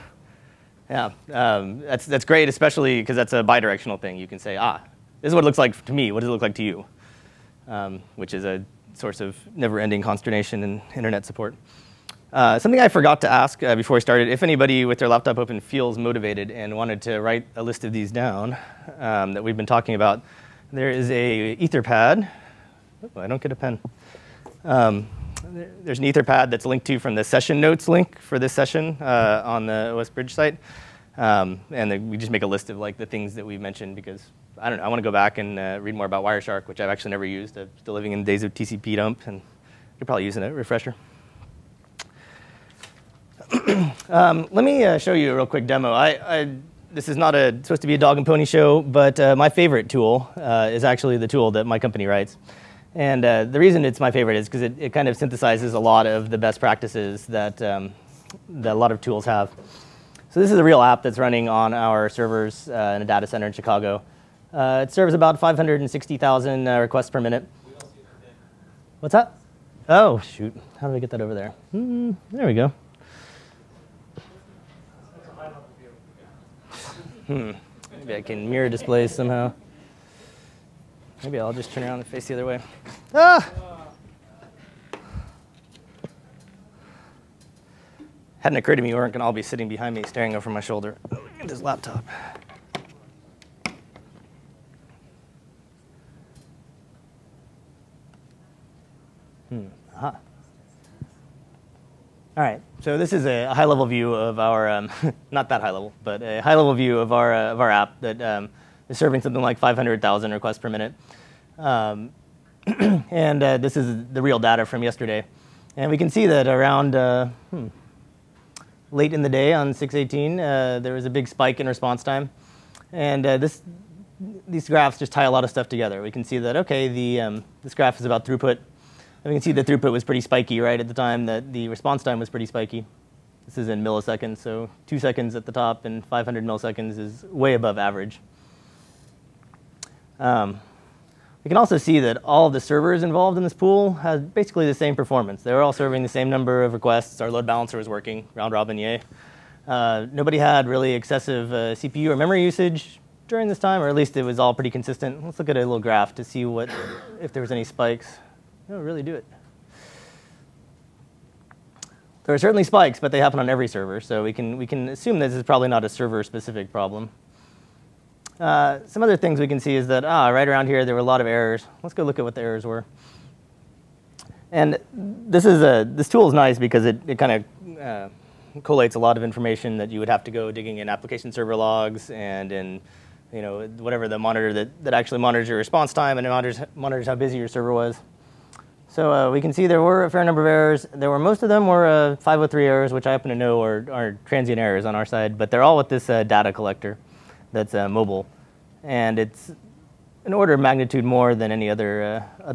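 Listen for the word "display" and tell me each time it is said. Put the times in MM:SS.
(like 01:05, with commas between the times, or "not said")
01:18.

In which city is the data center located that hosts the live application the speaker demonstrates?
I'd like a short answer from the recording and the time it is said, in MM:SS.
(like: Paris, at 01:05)
Chicago, at 01:03.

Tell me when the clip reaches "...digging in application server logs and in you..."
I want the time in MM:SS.
03:00.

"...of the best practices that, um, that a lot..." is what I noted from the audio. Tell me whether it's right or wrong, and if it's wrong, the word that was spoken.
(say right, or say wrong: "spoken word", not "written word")
right.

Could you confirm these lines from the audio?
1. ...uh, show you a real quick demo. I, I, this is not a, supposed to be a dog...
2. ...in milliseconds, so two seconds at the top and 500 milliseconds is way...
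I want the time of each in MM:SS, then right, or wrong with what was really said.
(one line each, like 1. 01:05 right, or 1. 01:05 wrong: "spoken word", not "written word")
1. 00:44 right
2. 02:13 right.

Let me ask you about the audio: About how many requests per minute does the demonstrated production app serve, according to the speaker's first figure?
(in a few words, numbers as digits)
560,000.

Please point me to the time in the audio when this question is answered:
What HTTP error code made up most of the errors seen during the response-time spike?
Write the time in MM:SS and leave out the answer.
03:12.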